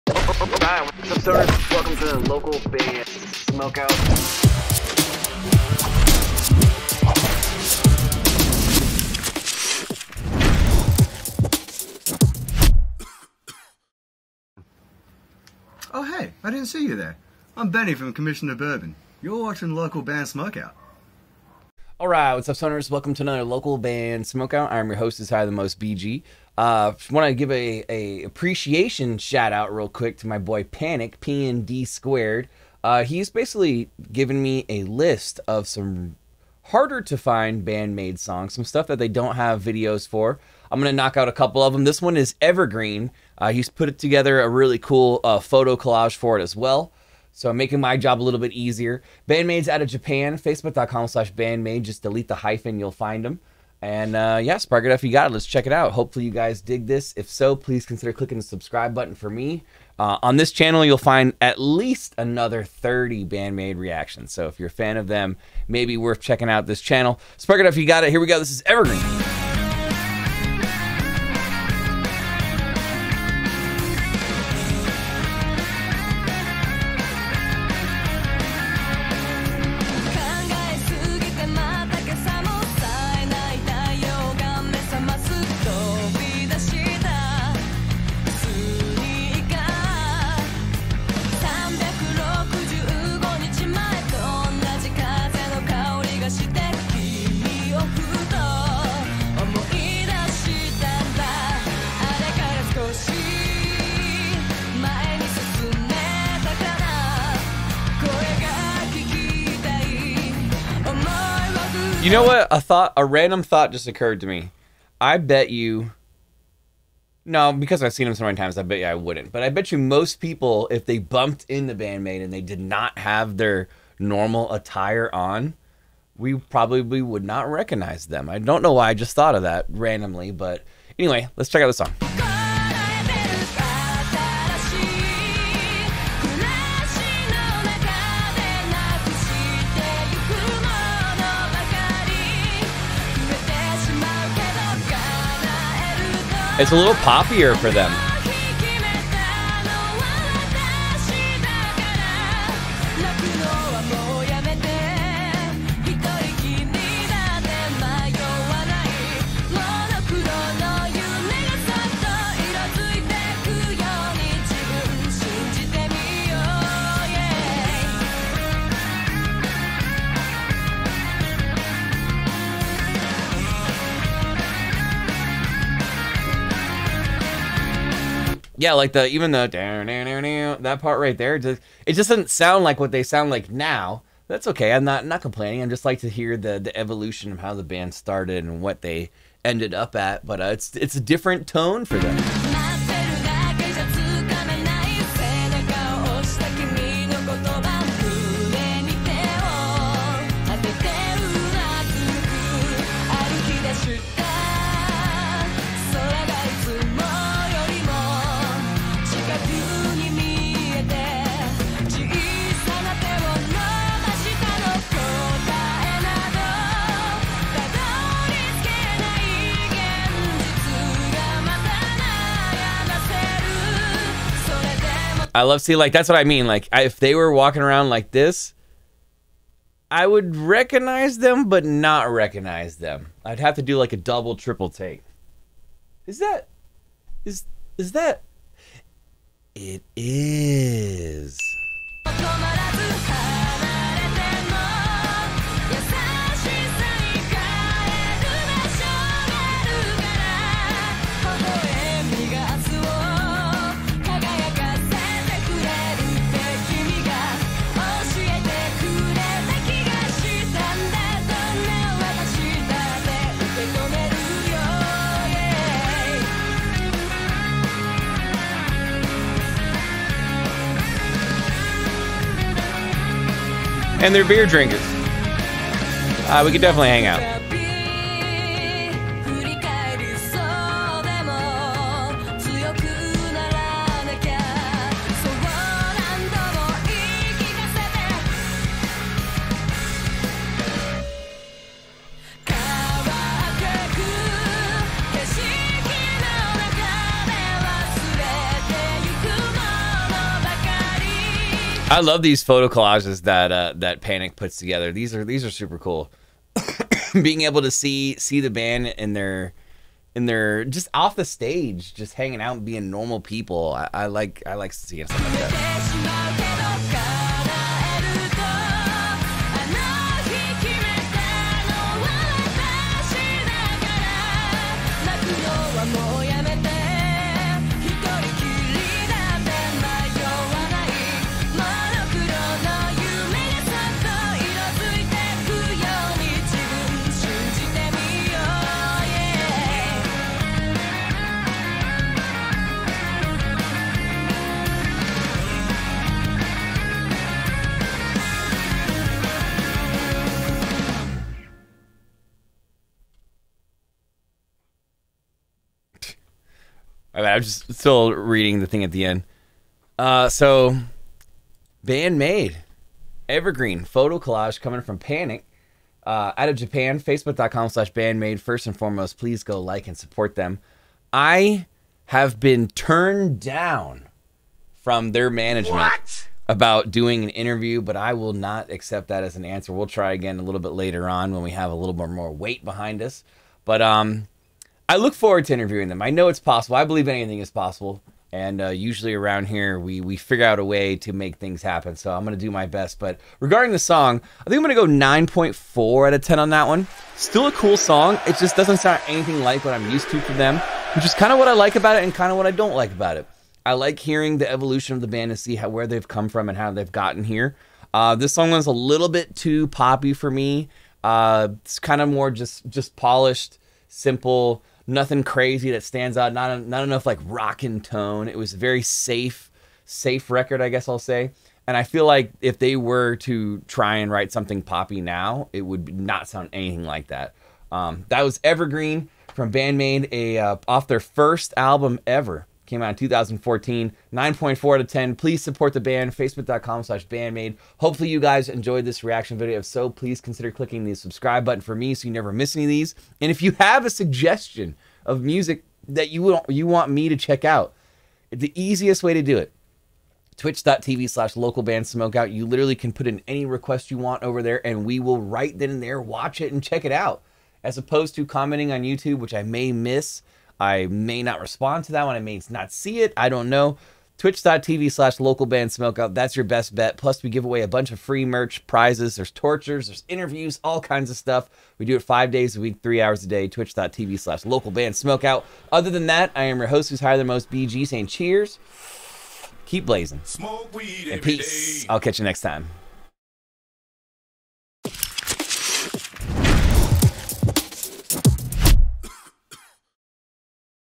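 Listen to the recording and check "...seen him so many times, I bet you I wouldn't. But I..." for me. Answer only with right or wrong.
right.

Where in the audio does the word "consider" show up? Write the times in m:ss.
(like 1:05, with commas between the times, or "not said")
0:57, 7:20.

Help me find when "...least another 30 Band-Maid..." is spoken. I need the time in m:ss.
1:01.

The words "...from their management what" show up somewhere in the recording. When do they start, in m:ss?
6:14.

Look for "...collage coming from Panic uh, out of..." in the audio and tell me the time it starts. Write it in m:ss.
6:04.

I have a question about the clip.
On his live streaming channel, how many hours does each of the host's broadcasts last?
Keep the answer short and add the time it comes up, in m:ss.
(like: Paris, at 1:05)
3, at 7:52.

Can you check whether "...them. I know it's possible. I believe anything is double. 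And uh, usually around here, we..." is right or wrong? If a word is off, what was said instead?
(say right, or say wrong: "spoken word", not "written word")
wrong: "possible", not "double".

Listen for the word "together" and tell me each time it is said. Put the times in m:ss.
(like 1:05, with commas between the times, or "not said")
0:43, 5:04.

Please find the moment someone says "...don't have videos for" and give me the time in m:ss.
0:39.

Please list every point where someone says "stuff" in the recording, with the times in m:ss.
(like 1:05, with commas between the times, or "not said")
0:38, 7:51.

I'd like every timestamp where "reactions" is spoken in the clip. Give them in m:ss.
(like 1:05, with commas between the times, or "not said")
1:03, 7:19.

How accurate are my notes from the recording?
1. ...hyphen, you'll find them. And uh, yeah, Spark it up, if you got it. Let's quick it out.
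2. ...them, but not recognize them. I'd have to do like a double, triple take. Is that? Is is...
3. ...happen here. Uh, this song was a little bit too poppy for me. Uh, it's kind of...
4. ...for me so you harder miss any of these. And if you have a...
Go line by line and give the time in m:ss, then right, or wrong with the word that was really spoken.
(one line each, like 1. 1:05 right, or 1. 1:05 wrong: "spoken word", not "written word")
1. 0:52 wrong: "check", not "quick"
2. 3:51 right
3. 6:46 wrong: "gotten", not "happen"
4. 7:21 wrong: "never", not "harder".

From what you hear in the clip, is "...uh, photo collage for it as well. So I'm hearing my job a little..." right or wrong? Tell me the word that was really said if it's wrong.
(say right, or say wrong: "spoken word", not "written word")
wrong: "making", not "hearing".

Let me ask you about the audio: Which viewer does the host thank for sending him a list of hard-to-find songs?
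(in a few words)
Panic P and D squared.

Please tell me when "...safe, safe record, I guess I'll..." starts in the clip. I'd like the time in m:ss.
6:58.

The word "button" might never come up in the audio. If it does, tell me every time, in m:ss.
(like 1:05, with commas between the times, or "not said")
0:58, 7:21.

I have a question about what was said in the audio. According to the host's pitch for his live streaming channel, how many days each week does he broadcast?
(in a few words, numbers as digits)
5.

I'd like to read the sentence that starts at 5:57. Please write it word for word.
I'm just still reading the thing at the end.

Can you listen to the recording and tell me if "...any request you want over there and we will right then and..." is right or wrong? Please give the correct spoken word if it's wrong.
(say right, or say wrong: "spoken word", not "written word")
right.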